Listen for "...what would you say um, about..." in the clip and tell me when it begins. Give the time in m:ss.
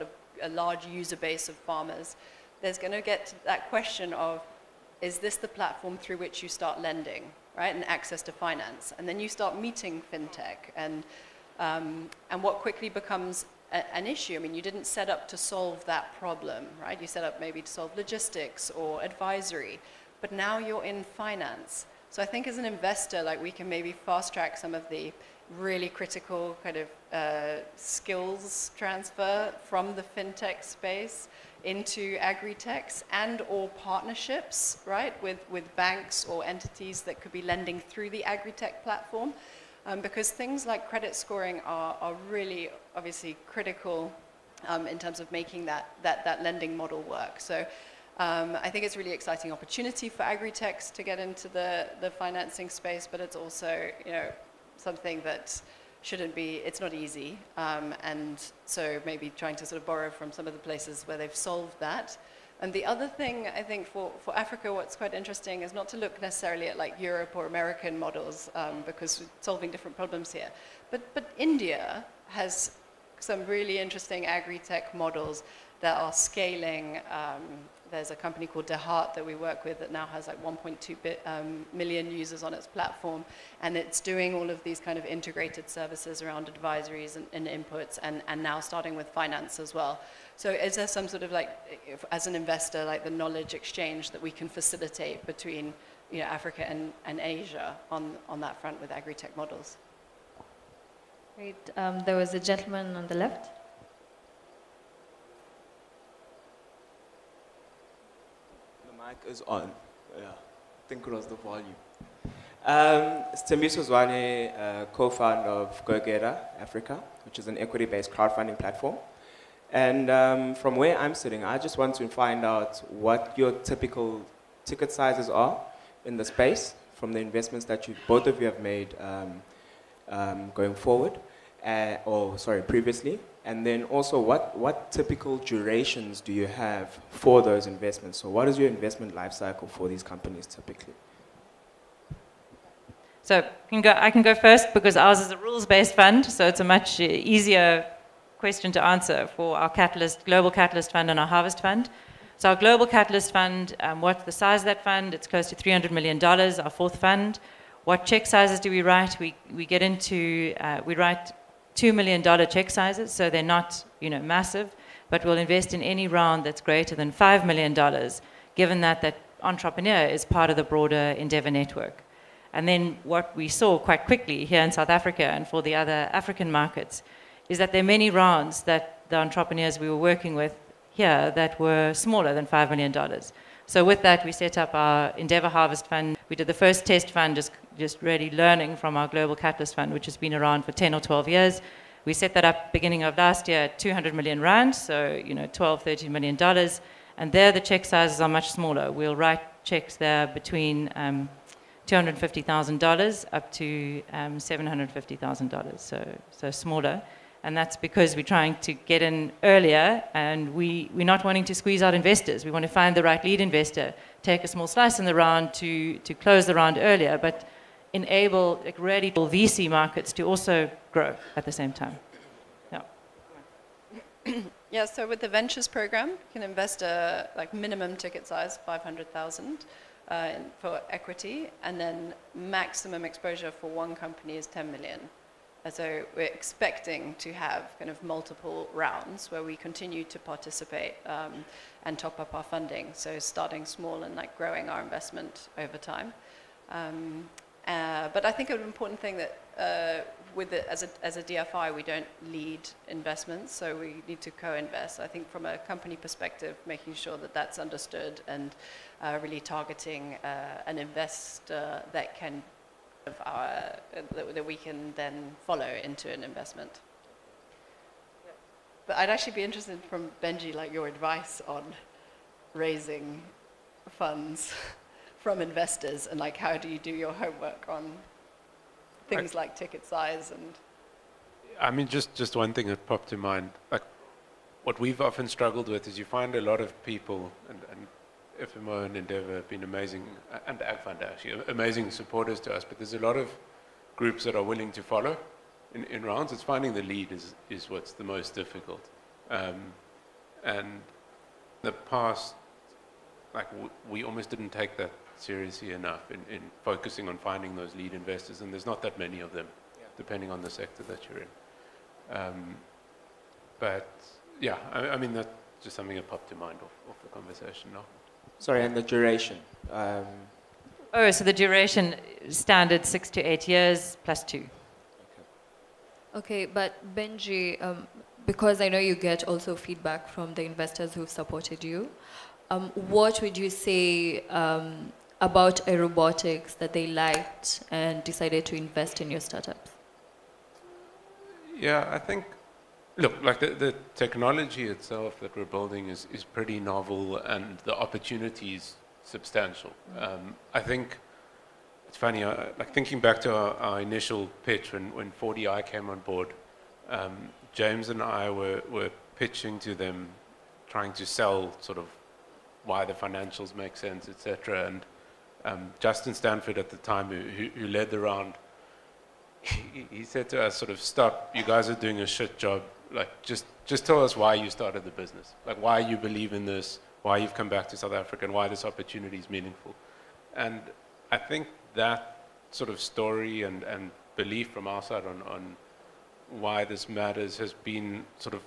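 5:32.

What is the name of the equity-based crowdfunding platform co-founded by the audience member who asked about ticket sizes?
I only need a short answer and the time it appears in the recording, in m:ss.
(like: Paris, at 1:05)
GoGeta Africa, at 1:55.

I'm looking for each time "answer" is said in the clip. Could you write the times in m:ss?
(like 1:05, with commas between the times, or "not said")
2:28.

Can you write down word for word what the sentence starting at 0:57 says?
Um, and so maybe trying to sort of borrow from some of the places where they've solved that.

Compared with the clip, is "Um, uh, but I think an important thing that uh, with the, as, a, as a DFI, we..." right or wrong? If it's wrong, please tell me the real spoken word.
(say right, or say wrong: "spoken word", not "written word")
right.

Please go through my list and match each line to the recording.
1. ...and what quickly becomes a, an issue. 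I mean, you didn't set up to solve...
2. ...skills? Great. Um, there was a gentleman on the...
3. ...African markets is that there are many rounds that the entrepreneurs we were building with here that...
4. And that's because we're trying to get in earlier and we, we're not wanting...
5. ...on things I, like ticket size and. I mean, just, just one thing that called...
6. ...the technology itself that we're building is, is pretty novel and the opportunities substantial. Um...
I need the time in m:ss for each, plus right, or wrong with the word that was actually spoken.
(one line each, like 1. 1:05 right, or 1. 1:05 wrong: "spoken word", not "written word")
1. 0:12 right
2. 1:39 wrong: "models", not "skills"
3. 2:56 wrong: "working", not "building"
4. 3:27 right
5. 4:37 wrong: "popped", not "called"
6. 5:43 right.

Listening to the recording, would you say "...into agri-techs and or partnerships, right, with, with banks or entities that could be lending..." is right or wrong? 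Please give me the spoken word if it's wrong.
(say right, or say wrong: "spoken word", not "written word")
right.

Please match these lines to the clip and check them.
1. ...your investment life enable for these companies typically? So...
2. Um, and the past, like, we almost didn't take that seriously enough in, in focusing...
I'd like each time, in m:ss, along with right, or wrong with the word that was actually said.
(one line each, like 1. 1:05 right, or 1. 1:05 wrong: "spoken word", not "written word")
1. 2:18 wrong: "cycle", not "enable"
2. 4:59 right.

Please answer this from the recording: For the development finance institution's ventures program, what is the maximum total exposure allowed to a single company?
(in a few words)
10 million.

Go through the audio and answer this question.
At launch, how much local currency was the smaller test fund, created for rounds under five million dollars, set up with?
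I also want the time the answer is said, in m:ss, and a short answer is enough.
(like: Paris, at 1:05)
200 million rand, at 3:13.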